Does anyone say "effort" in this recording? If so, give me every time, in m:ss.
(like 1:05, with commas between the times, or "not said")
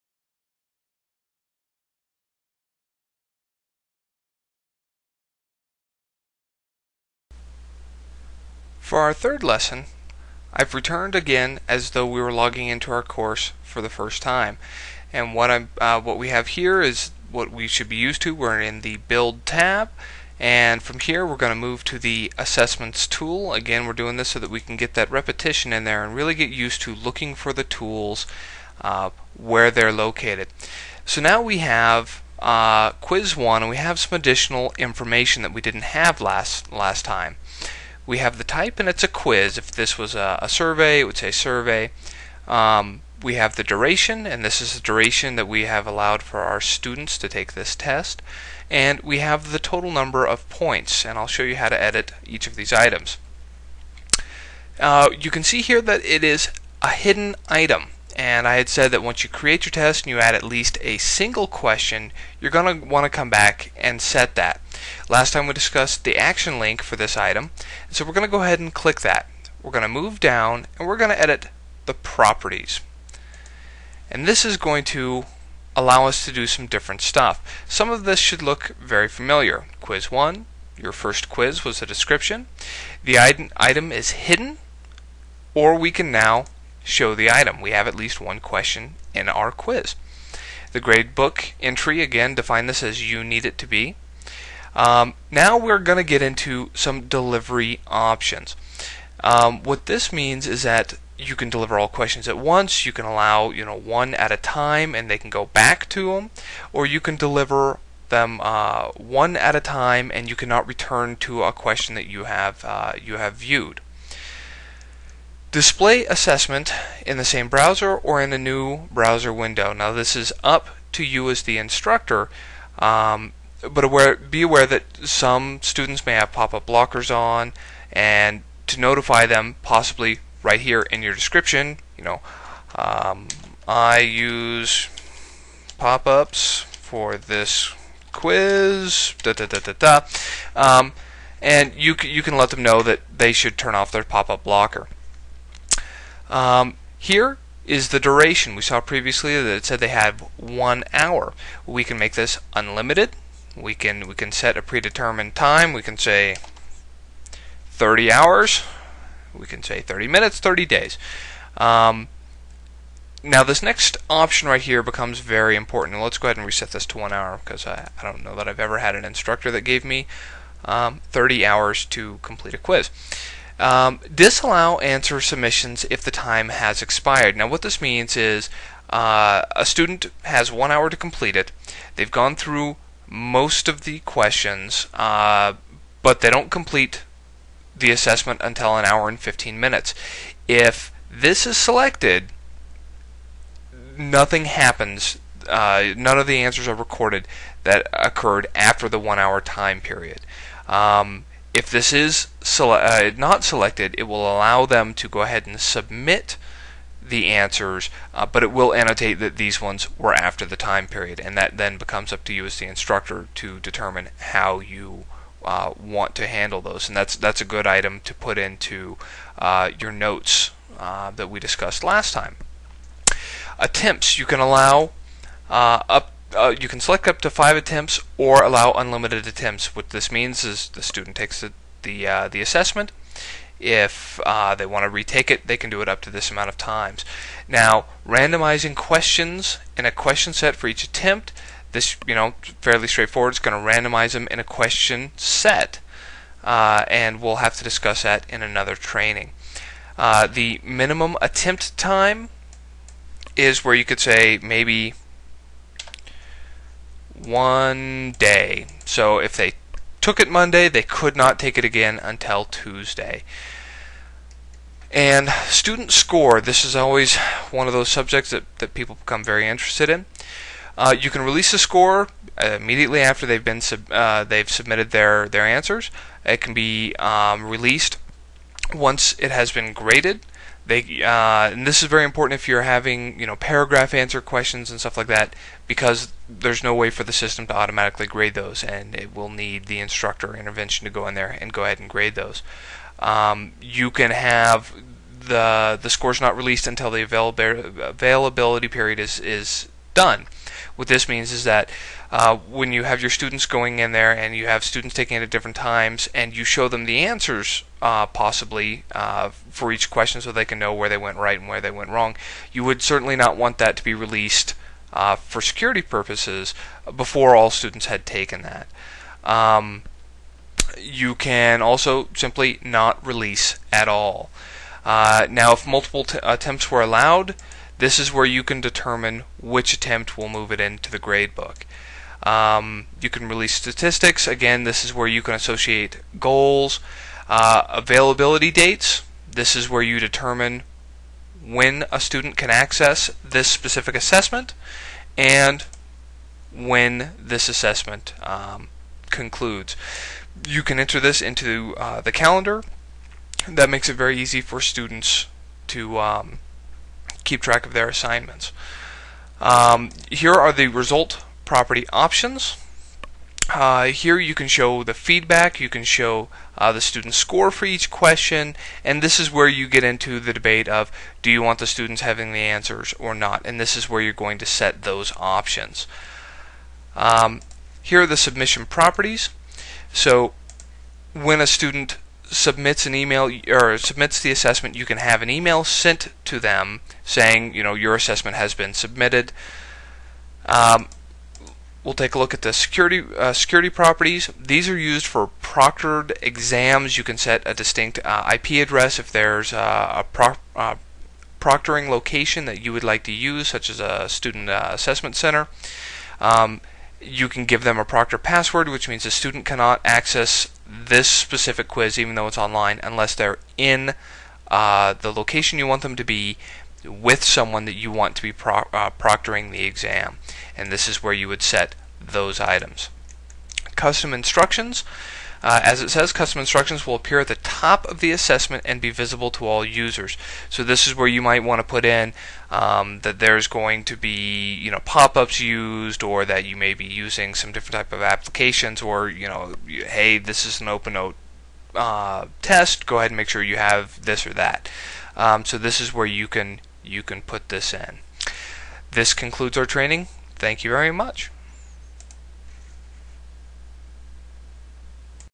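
not said.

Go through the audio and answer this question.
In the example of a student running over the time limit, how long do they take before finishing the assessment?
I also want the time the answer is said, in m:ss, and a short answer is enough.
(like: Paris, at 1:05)
an hour and 15 minutes, at 3:08.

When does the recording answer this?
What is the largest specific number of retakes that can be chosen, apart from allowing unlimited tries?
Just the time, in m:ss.
3:47.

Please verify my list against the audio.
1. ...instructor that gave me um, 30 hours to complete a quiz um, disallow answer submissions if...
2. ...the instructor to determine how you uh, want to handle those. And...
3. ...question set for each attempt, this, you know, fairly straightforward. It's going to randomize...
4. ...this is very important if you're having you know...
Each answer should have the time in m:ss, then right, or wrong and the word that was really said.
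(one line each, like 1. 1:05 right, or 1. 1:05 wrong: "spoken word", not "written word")
1. 2:49 right
2. 3:32 right
3. 3:59 right
4. 4:41 right.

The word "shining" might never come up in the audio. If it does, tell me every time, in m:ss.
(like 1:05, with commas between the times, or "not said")
not said.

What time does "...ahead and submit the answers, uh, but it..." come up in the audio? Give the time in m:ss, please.
3:25.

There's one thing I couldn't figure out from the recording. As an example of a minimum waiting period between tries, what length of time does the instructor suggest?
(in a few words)
1 day.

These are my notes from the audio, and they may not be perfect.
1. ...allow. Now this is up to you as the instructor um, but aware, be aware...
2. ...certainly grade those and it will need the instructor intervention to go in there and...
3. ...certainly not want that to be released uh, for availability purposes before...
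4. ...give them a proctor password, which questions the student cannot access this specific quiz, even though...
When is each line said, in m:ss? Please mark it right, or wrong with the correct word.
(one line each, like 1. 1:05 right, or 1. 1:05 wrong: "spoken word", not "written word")
1. 1:59 wrong: "window", not "allow"
2. 4:47 wrong: "automatically", not "certainly"
3. 5:12 wrong: "security", not "availability"
4. 6:47 wrong: "means", not "questions".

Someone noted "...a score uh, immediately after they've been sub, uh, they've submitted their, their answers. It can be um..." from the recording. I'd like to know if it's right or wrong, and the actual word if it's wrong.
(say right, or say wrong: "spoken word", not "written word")
right.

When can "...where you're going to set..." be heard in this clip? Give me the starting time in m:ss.
6:13.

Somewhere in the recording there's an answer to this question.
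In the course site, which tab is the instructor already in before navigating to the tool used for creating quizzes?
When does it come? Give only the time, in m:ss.
0:18.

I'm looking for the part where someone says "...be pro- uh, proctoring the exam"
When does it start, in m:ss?
6:58.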